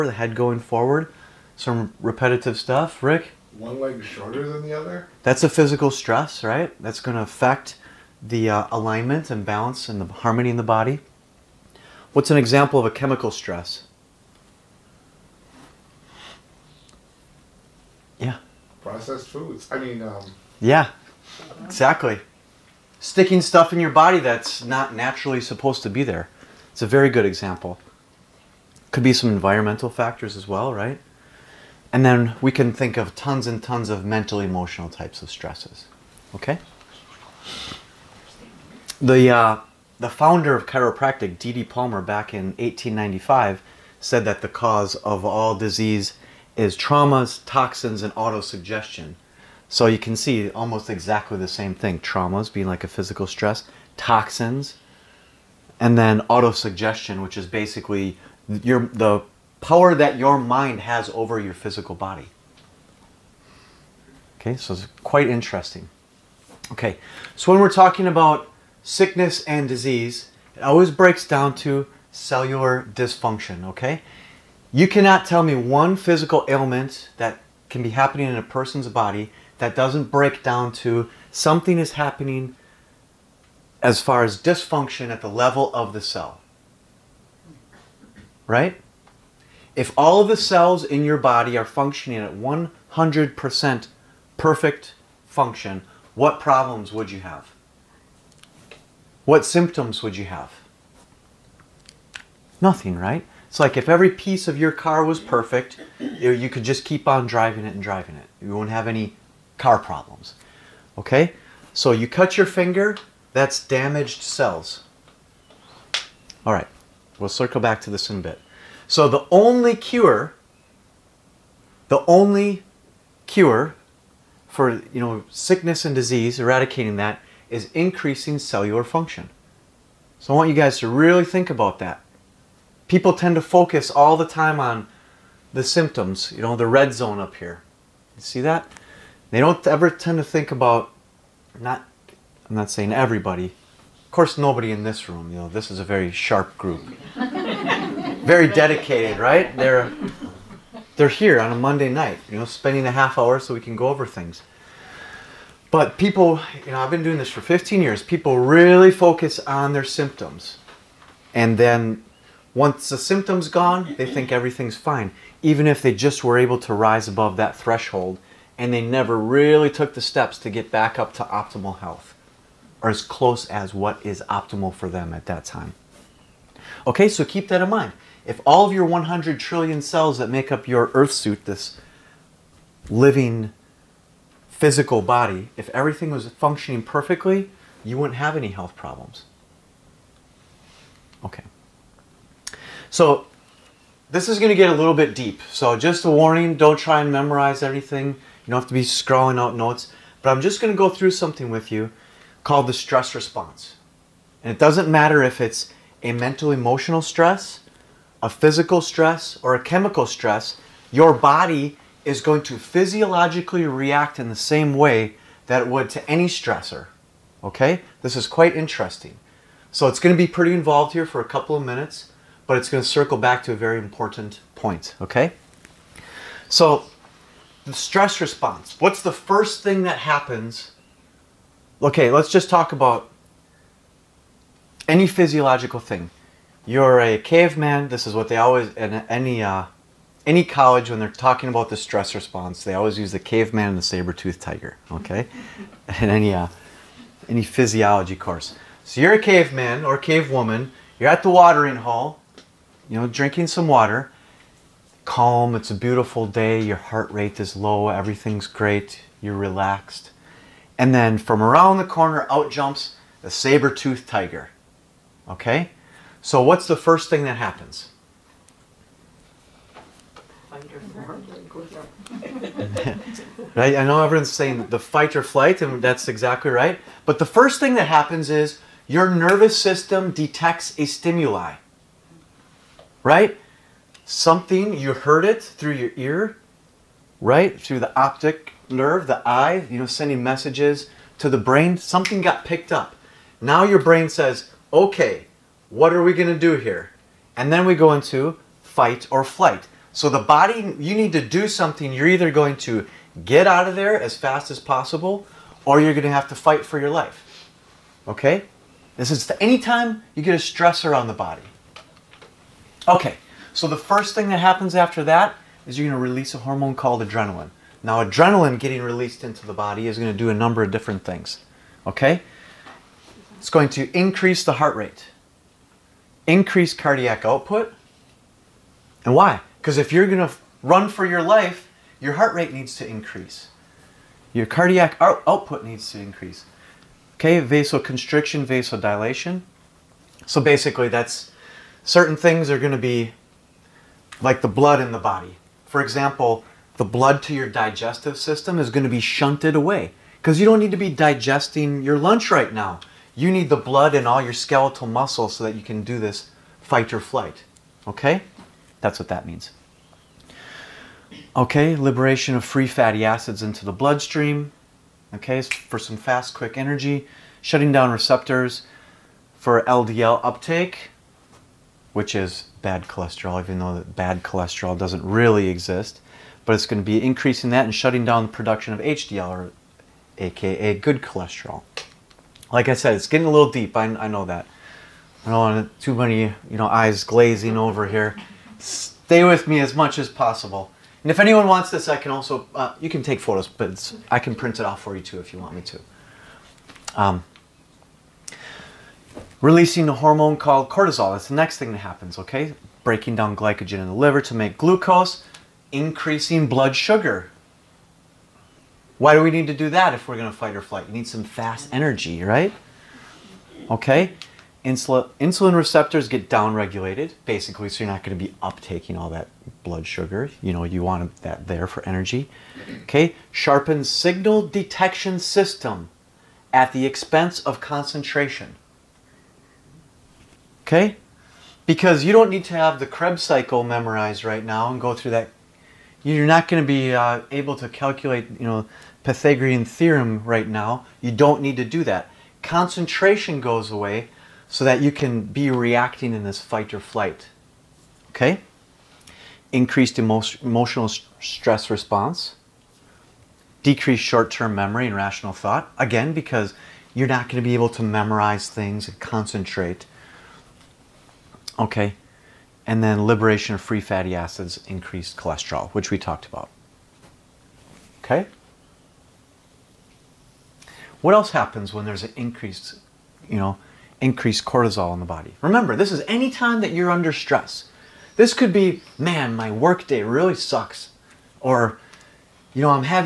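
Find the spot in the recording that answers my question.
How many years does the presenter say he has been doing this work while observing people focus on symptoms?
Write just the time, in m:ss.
2:37.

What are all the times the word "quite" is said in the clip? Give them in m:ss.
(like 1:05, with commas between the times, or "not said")
1:05, 3:38.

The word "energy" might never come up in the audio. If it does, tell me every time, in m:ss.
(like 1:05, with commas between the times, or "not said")
6:06, 6:51, 7:01.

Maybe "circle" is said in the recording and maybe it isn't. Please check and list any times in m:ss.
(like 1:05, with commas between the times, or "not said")
1:57, 3:42.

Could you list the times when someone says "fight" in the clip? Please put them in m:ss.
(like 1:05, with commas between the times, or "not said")
4:34, 4:58, 5:06, 5:56, 6:50, 7:26.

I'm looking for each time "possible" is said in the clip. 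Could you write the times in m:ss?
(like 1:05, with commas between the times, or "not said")
5:04, 6:30.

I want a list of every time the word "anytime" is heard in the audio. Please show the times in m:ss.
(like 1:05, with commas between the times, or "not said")
5:09.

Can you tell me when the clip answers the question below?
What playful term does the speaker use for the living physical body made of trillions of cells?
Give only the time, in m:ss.
3:00.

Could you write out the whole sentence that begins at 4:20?
And then from around the corner out jumps the saber-toothed tiger.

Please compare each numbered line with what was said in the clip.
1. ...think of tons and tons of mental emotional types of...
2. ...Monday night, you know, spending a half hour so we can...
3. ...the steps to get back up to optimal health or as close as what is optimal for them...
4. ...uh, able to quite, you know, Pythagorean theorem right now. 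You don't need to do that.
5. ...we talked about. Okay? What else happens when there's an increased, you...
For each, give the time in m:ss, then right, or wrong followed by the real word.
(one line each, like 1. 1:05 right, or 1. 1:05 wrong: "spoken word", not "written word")
1. 0:32 right
2. 2:31 right
3. 2:49 right
4. 7:16 wrong: "calculate", not "quite"
5. 7:45 right.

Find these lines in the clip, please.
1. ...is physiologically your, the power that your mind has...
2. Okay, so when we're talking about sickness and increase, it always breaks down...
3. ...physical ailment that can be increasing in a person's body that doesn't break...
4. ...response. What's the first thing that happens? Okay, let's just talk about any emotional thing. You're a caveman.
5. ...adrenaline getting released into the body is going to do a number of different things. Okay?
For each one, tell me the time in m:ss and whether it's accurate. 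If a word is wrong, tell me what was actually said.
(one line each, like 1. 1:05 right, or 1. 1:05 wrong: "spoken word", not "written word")
1. 0:57 wrong: "basically", not "physiologically"
2. 1:06 wrong: "disease", not "increase"
3. 1:15 wrong: "happening", not "increasing"
4. 3:48 wrong: "physiological", not "emotional"
5. 5:18 right.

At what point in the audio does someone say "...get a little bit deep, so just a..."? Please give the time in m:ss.
3:14.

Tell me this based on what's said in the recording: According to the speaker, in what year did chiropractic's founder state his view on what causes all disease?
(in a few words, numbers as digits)
1895.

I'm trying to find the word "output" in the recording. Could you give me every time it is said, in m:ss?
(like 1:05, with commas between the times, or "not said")
5:27, 5:34.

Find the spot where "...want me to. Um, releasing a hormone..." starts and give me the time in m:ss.
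6:35.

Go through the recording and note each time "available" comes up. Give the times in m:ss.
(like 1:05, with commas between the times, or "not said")
not said.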